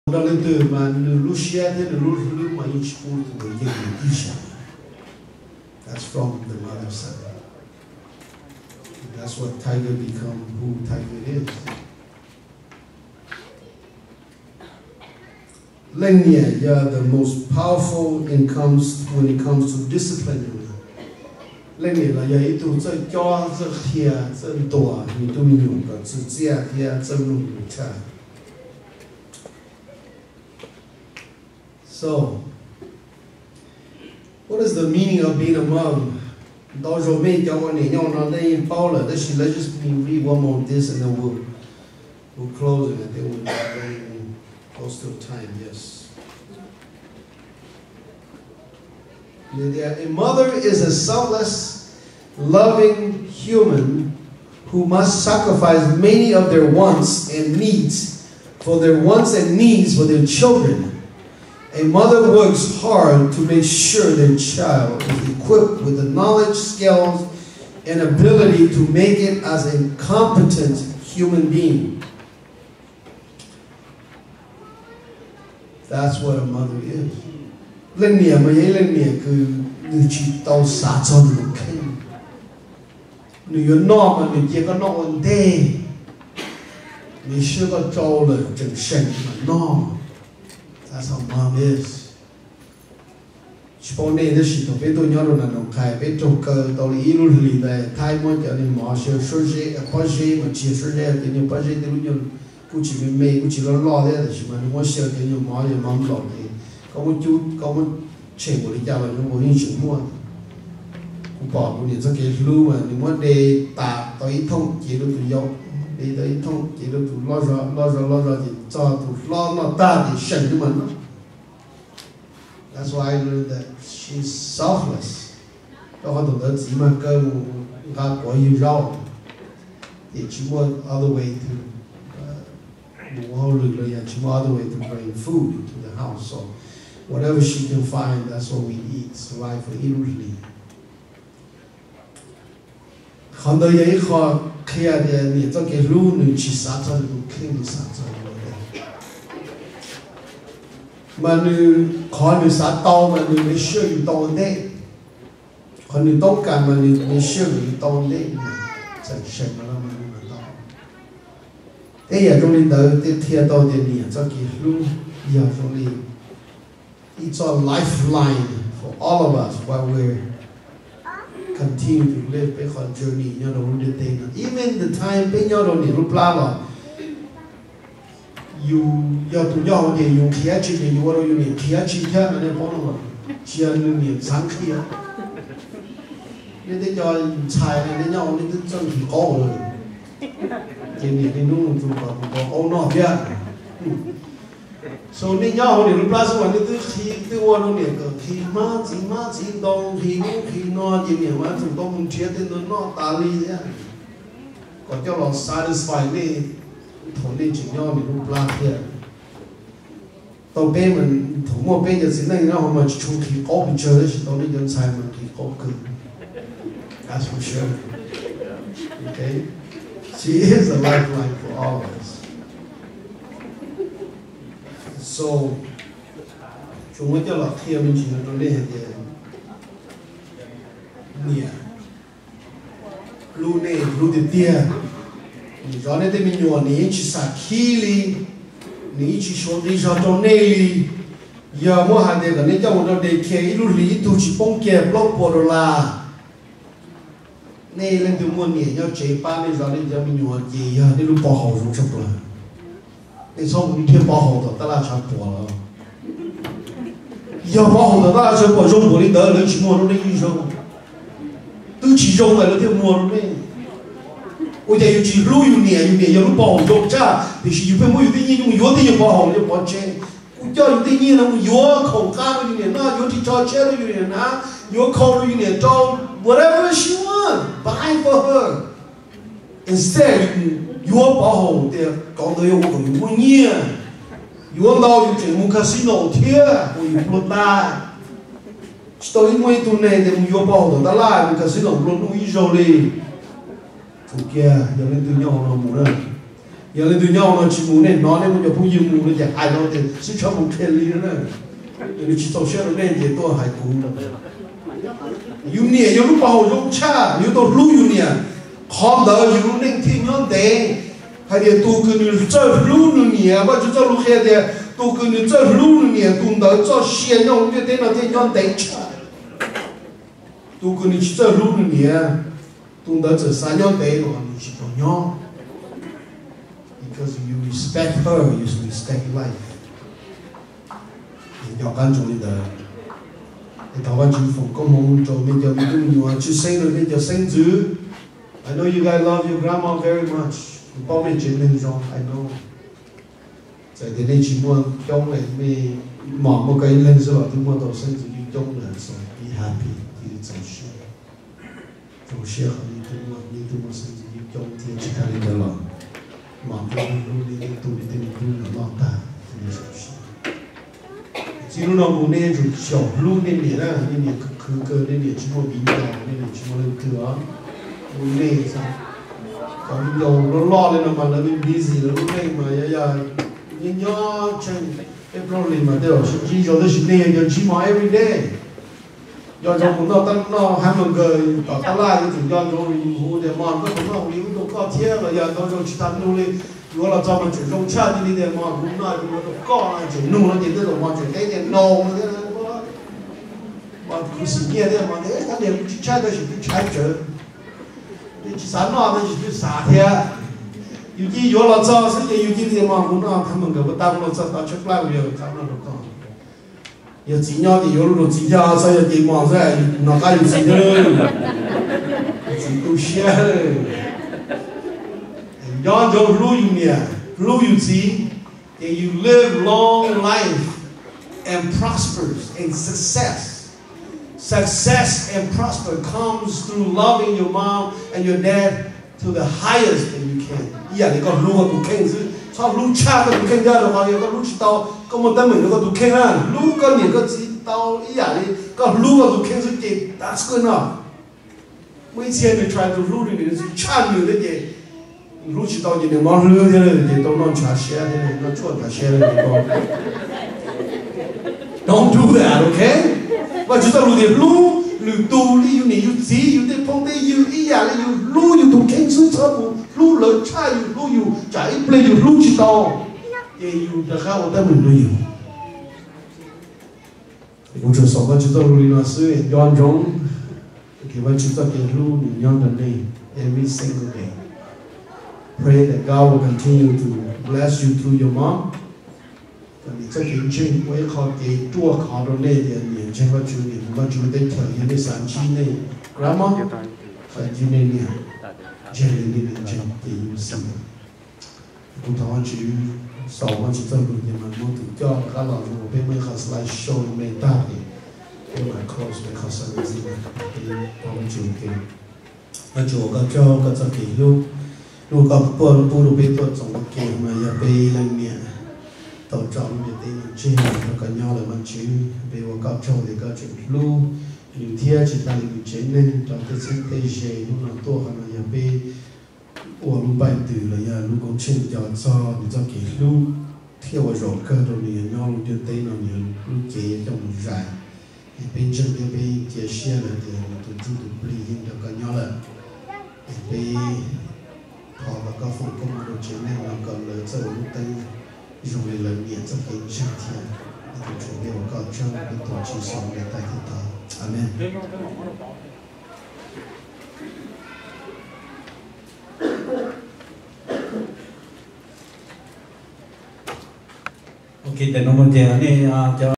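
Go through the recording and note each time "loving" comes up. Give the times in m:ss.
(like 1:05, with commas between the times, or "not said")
0:52, 7:06.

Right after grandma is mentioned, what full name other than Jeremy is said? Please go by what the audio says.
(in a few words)
Jim Stevenson.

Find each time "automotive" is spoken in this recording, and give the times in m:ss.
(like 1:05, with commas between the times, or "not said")
not said.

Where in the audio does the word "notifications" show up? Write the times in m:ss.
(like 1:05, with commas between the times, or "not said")
not said.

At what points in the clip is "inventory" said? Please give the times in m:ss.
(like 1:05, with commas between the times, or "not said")
not said.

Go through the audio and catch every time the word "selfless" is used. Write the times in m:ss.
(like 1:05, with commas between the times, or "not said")
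0:50, 2:04.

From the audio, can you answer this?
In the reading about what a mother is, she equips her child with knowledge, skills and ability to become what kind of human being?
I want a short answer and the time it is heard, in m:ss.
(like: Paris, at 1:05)
competent, at 1:09.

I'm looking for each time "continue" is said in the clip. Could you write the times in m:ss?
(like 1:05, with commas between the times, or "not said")
2:51, 7:56.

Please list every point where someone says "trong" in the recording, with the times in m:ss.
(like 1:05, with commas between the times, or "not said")
4:02, 8:26, 8:46.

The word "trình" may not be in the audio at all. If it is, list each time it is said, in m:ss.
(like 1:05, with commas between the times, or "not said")
8:00, 8:41.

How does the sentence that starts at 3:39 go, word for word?
Okay, she is a lifeline for all of us.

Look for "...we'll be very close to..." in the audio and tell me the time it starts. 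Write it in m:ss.
0:43.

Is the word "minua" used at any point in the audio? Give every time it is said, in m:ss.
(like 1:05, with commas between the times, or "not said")
3:56, 4:10.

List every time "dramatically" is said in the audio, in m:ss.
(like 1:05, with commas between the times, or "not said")
not said.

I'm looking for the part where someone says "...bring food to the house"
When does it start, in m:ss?
2:14.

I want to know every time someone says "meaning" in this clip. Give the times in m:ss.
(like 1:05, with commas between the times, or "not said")
0:34.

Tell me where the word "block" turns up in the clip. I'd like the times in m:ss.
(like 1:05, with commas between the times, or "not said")
4:04.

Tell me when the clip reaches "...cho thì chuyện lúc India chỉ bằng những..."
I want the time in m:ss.
8:32.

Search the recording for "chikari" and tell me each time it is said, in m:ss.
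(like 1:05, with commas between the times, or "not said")
5:54.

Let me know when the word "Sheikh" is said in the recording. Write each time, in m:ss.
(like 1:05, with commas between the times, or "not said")
5:52.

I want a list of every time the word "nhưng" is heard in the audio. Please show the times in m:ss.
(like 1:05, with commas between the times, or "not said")
8:14, 8:51.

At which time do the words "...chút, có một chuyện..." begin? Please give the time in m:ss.
1:47.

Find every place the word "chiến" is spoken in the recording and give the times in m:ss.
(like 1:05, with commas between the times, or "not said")
8:35, 8:56.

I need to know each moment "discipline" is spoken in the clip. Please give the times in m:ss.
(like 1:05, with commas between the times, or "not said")
0:19.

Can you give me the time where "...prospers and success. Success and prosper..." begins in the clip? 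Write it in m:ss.
7:01.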